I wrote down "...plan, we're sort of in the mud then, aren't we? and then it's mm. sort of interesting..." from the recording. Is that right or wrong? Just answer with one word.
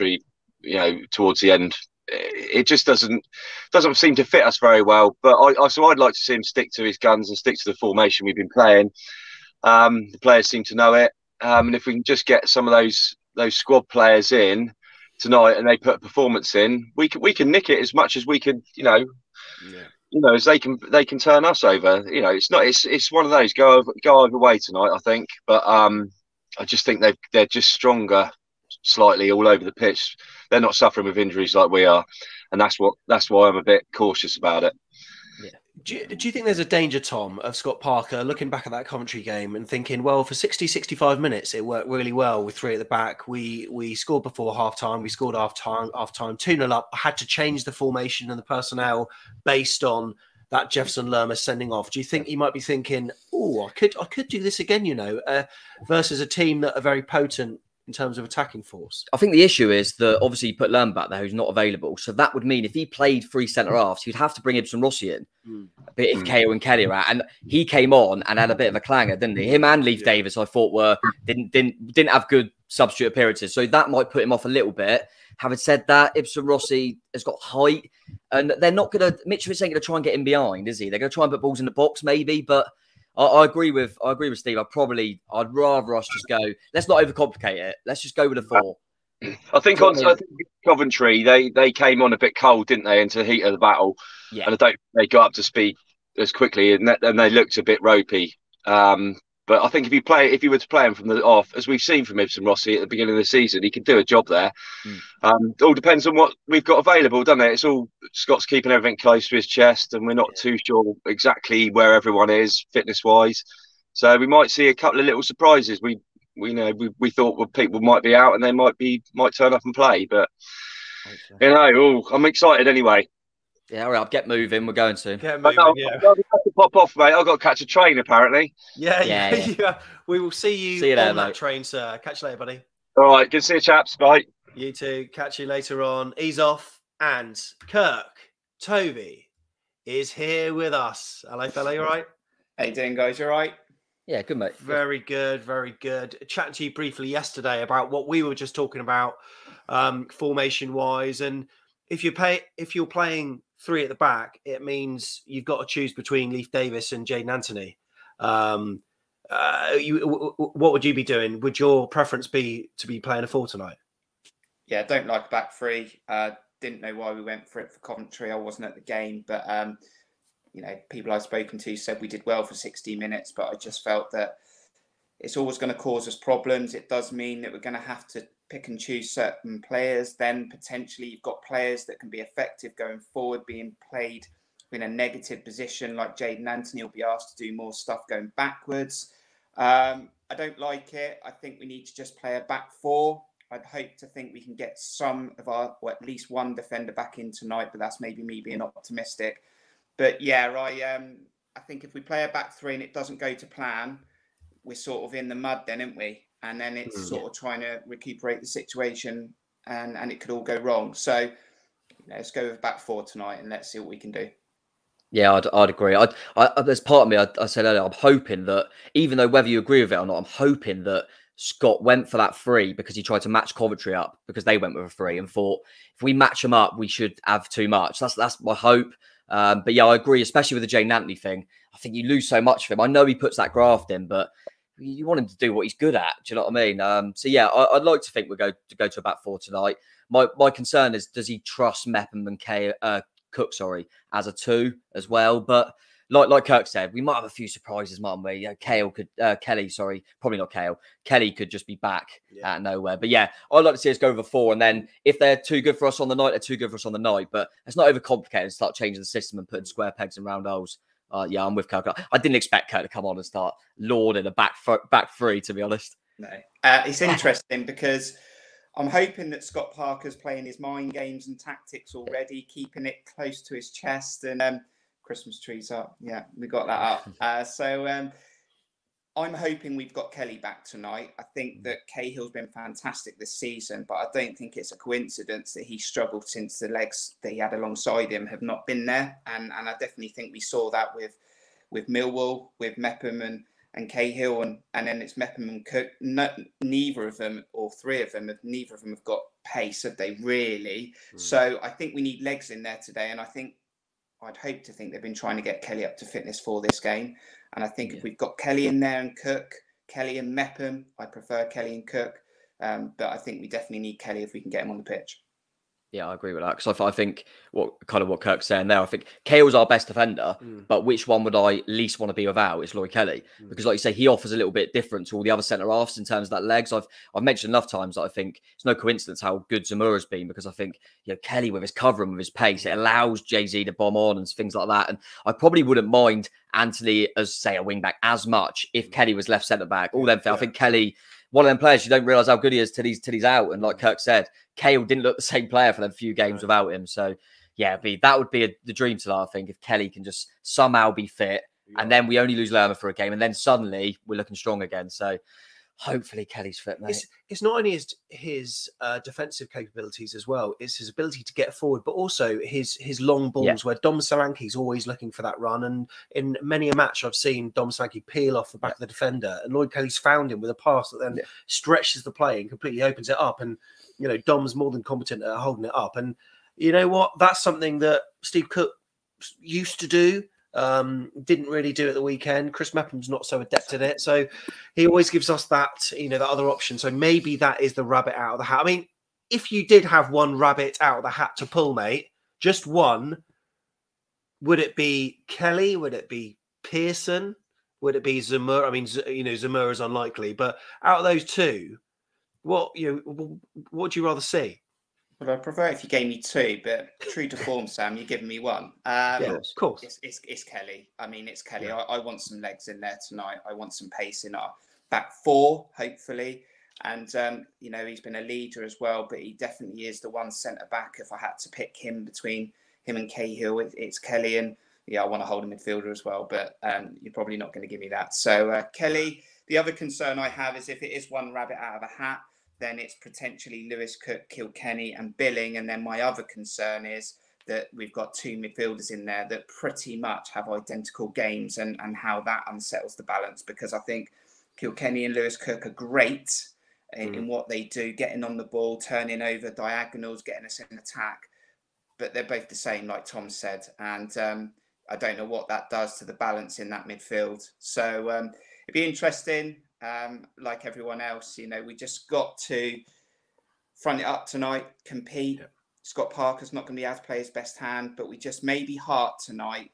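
wrong.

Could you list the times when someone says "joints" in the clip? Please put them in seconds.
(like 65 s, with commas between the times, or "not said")
not said.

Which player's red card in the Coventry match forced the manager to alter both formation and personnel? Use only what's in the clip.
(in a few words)
Jefferson Lerma.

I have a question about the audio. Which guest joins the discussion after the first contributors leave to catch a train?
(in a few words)
Toby.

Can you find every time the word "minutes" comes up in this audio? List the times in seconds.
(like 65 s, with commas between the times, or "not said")
41 s, 172 s.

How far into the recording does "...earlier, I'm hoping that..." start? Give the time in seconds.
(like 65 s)
217 s.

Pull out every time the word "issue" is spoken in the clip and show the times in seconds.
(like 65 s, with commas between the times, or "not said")
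59 s.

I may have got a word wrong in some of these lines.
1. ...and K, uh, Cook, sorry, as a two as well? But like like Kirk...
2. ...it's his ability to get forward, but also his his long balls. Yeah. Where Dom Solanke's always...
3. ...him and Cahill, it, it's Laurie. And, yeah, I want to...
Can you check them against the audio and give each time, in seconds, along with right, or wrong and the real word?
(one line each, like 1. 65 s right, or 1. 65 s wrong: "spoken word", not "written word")
1. 242 s right
2. 360 s right
3. 422 s wrong: "Kelly", not "Laurie".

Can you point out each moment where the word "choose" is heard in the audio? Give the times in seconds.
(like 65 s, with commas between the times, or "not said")
155 s, 178 s.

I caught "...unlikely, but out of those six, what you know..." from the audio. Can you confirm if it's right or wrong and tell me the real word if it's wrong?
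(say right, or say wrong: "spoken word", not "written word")
wrong: "two", not "six".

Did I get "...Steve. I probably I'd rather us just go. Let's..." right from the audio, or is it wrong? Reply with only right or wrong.
right.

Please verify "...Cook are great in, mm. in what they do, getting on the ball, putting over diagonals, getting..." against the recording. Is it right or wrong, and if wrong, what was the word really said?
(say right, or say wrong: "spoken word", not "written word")
wrong: "turning", not "putting".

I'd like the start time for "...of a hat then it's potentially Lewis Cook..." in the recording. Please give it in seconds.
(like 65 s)
431 s.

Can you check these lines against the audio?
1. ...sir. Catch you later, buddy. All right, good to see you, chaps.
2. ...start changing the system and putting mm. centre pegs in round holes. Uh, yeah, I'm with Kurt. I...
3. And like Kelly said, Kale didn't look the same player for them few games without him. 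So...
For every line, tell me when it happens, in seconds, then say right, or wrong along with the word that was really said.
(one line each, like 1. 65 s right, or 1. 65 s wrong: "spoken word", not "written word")
1. 131 s right
2. 258 s wrong: "square", not "centre"
3. 343 s wrong: "Kirk", not "Kelly".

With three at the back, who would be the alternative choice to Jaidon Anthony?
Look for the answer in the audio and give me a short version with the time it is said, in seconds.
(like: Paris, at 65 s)
Leif Davis, at 156 s.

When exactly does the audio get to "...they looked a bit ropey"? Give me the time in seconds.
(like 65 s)
97 s.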